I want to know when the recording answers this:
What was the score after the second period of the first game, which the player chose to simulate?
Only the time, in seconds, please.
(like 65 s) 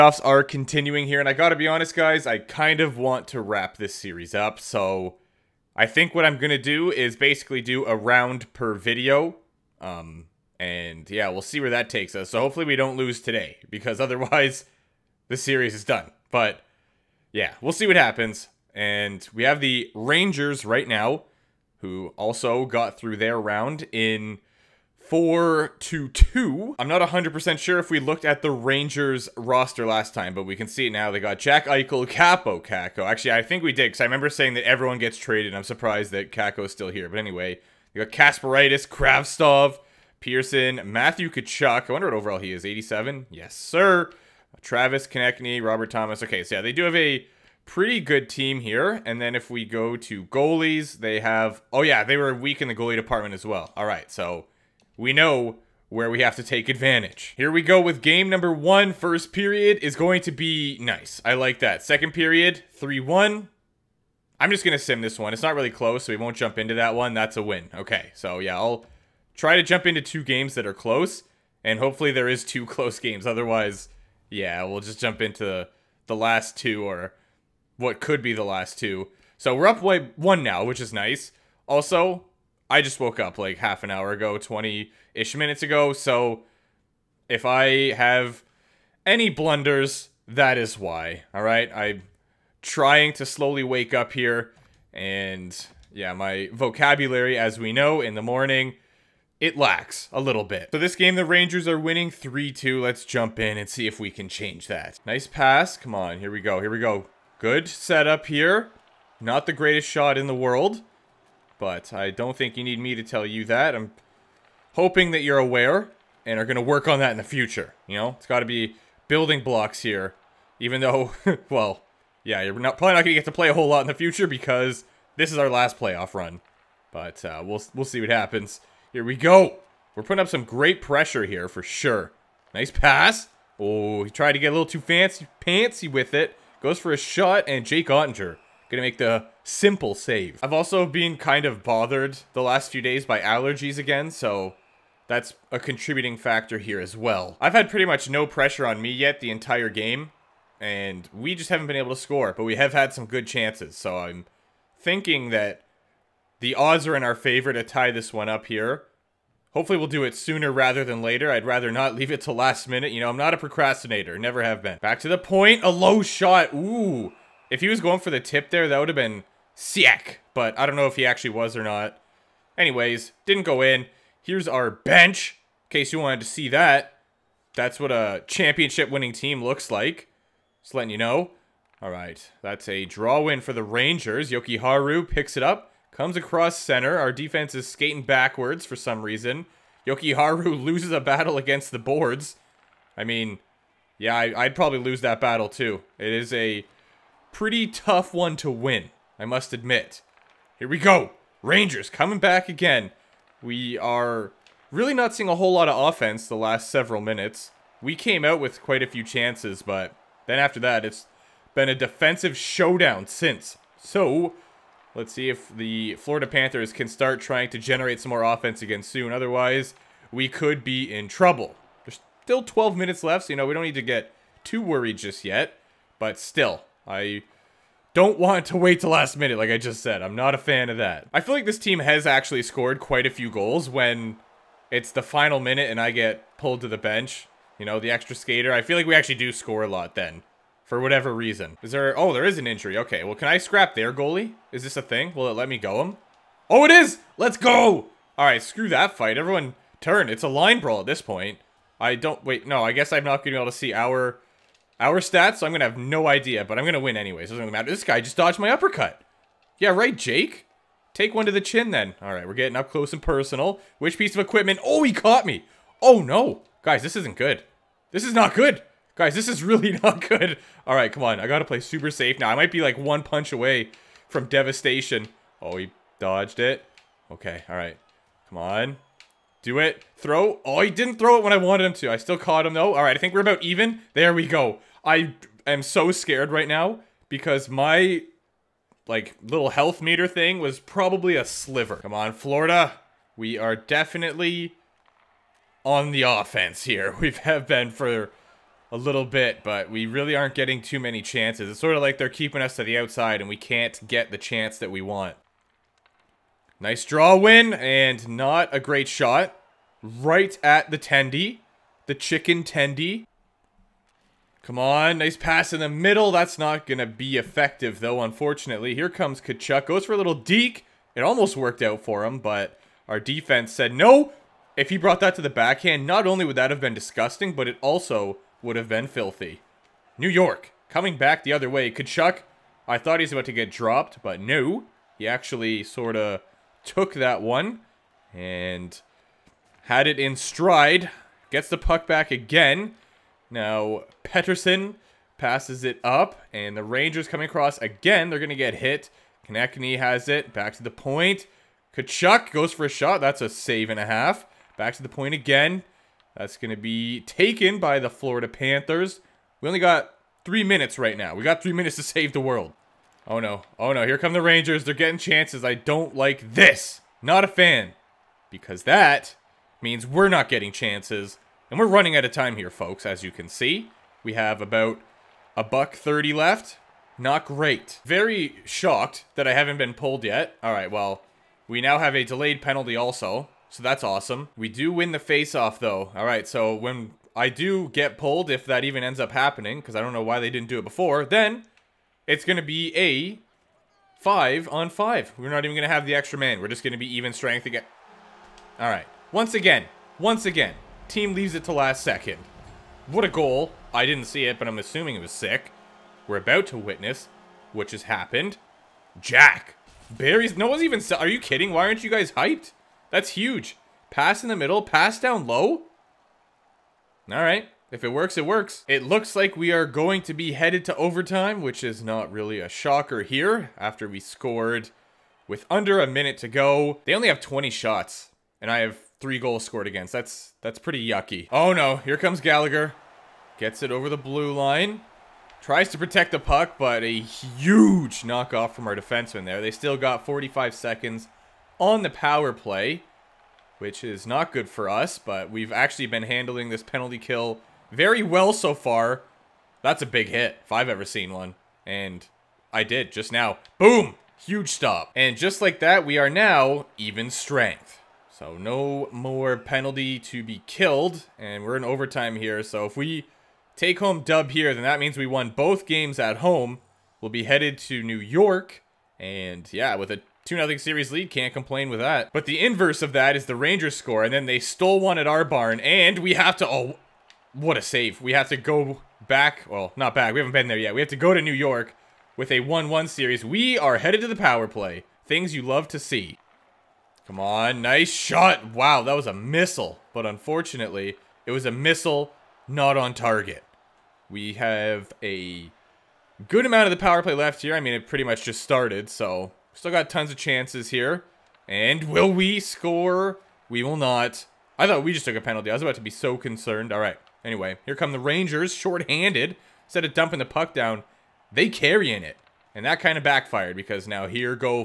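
62 s.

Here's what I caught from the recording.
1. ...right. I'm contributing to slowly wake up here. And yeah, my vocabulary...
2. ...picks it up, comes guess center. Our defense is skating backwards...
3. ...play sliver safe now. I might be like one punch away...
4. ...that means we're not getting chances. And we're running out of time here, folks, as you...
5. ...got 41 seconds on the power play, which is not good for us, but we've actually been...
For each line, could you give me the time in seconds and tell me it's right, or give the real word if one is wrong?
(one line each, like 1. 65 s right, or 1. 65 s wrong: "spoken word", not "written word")
1. 91 s wrong: "trying", not "contributing"
2. 185 s wrong: "across", not "guess"
3. 271 s wrong: "super", not "sliver"
4. 368 s right
5. 439 s wrong: "45", not "41".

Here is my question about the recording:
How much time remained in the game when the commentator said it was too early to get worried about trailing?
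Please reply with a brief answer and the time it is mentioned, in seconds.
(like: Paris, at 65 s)
12 minutes, at 222 s.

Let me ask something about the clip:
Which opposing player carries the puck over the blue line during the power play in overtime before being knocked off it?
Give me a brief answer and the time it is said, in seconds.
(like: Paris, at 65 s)
Gallagher, at 432 s.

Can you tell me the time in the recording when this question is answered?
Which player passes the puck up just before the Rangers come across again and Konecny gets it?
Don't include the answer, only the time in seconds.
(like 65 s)
344 s.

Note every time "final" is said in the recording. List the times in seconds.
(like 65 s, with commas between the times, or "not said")
235 s.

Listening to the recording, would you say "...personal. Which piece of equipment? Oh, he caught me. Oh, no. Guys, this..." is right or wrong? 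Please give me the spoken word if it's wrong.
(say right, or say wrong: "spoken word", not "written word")
right.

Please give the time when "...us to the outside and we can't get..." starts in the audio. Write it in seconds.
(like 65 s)
302 s.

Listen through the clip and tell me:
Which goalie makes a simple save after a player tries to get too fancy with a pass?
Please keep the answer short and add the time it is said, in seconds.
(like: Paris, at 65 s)
Jake Oettinger, at 137 s.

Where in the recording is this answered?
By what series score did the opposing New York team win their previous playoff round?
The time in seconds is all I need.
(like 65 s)
25 s.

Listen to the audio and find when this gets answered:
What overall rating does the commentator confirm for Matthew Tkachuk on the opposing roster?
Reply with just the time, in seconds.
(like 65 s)
42 s.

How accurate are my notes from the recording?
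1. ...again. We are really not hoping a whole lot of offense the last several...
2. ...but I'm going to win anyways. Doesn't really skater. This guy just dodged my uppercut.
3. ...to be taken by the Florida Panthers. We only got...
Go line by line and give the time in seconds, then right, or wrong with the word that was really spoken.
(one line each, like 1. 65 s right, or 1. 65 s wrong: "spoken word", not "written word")
1. 202 s wrong: "seeing", not "hoping"
2. 256 s wrong: "matter", not "skater"
3. 356 s right.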